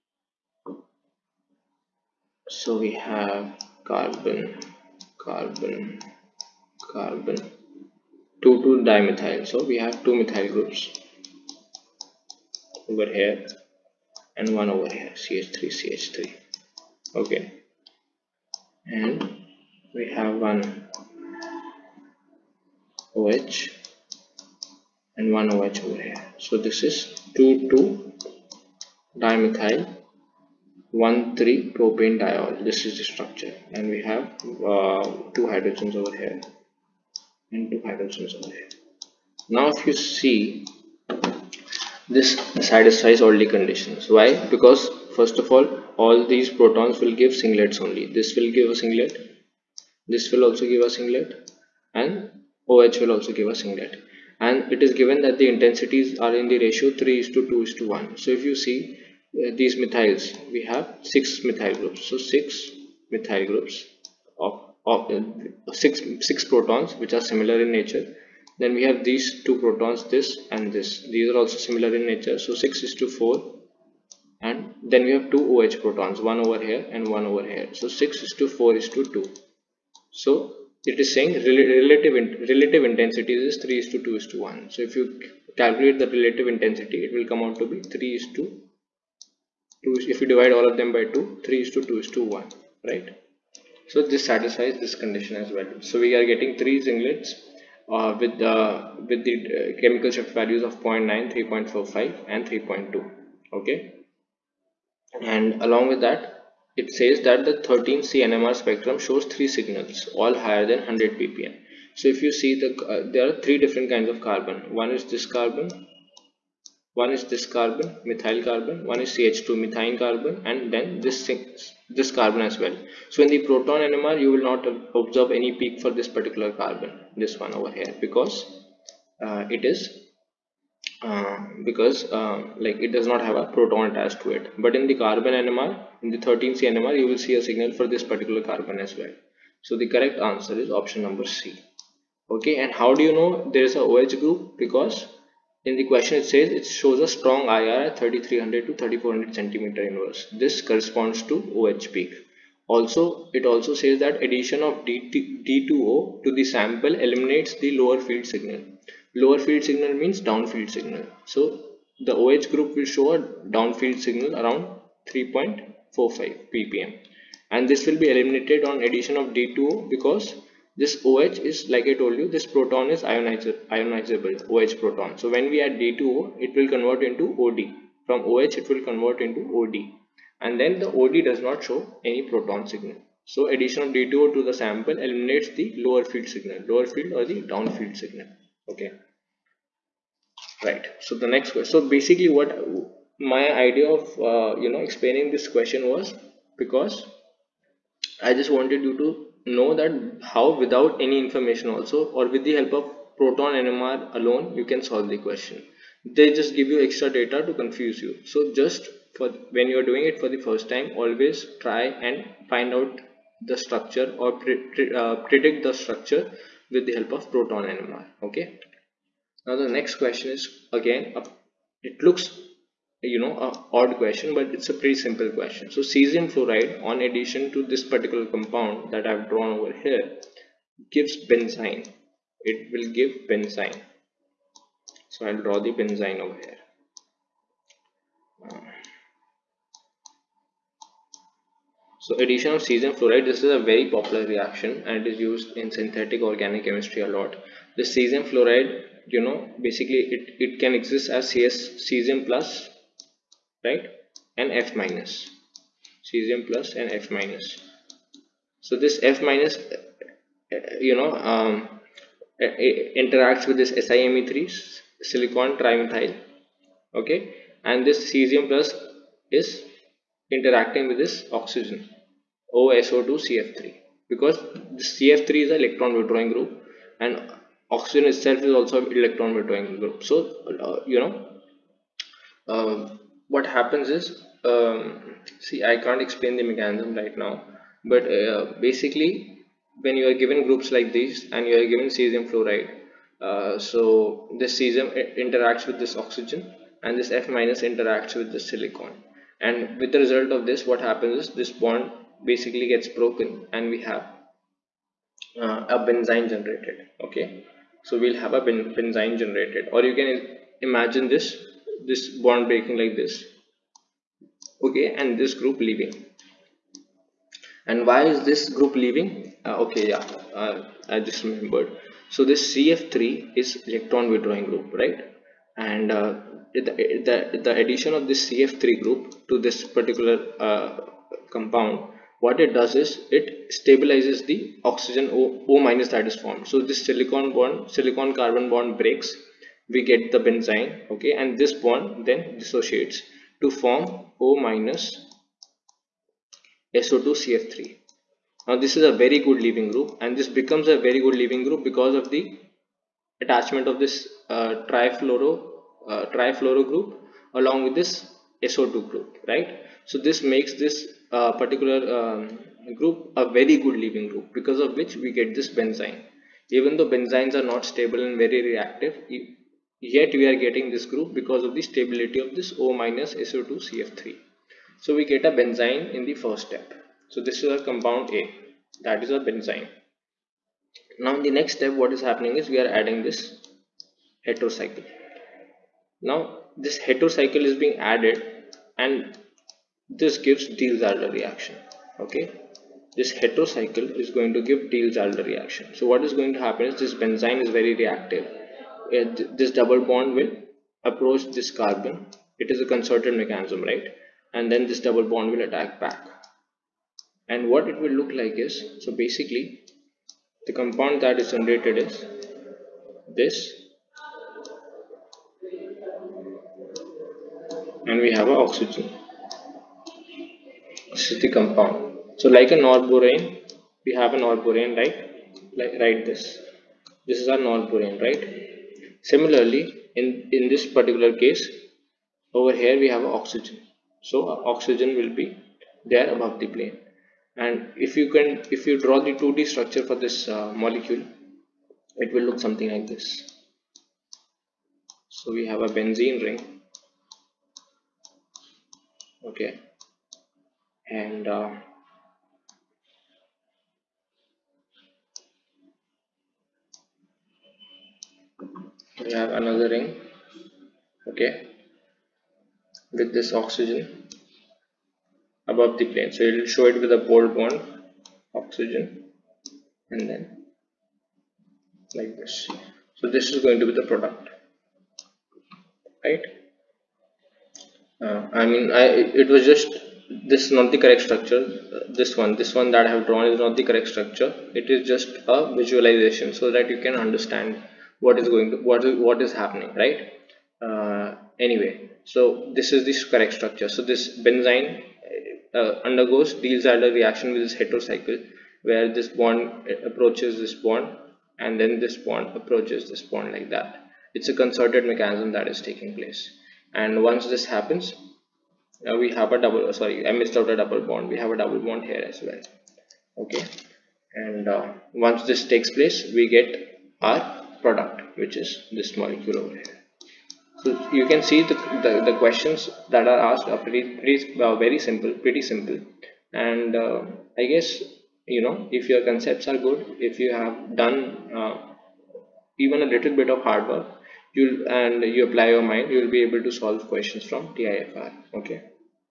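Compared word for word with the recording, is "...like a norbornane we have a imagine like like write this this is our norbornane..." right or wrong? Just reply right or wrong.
wrong.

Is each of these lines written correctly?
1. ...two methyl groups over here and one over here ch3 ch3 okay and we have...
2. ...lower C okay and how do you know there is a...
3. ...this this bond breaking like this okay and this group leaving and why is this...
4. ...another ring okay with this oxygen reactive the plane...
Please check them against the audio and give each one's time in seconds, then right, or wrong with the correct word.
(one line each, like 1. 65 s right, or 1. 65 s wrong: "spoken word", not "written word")
1. 10 s right
2. 141 s wrong: "number", not "lower"
3. 311 s right
4. 459 s wrong: "above", not "reactive".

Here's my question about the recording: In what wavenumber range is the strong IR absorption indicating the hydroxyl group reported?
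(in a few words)
3300 to 3400 cm⁻¹.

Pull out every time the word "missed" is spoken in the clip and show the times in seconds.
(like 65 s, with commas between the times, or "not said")
510 s.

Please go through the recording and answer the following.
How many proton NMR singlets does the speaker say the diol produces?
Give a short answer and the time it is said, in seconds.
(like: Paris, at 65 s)
3, at 96 s.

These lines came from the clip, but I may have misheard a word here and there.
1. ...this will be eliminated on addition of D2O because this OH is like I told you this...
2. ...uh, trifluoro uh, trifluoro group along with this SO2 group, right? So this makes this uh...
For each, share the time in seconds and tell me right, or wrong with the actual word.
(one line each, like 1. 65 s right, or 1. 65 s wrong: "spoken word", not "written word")
1. 167 s right
2. 354 s right.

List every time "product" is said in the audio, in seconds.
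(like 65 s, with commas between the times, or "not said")
473 s, 517 s.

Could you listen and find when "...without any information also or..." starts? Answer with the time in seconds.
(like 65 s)
200 s.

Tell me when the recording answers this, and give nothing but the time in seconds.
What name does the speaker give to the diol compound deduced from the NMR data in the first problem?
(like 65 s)
27 s.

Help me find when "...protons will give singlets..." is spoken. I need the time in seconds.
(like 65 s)
46 s.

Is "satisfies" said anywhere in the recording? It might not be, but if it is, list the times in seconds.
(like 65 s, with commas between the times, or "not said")
42 s, 94 s.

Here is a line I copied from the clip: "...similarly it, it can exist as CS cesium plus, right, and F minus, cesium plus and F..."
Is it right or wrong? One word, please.
wrong.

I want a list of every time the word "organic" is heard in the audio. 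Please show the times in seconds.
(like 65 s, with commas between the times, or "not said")
246 s.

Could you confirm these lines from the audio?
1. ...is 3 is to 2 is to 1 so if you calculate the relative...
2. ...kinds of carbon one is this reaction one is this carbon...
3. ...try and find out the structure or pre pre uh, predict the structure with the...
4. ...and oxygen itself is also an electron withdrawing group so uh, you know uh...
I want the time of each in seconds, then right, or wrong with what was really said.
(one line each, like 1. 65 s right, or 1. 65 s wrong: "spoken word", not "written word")
1. 83 s right
2. 113 s wrong: "carbon", not "reaction"
3. 211 s right
4. 276 s right.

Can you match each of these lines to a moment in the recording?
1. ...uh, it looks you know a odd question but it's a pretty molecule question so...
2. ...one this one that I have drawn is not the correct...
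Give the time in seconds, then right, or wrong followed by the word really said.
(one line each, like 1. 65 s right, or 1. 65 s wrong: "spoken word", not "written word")
1. 221 s wrong: "simple", not "molecule"
2. 482 s right.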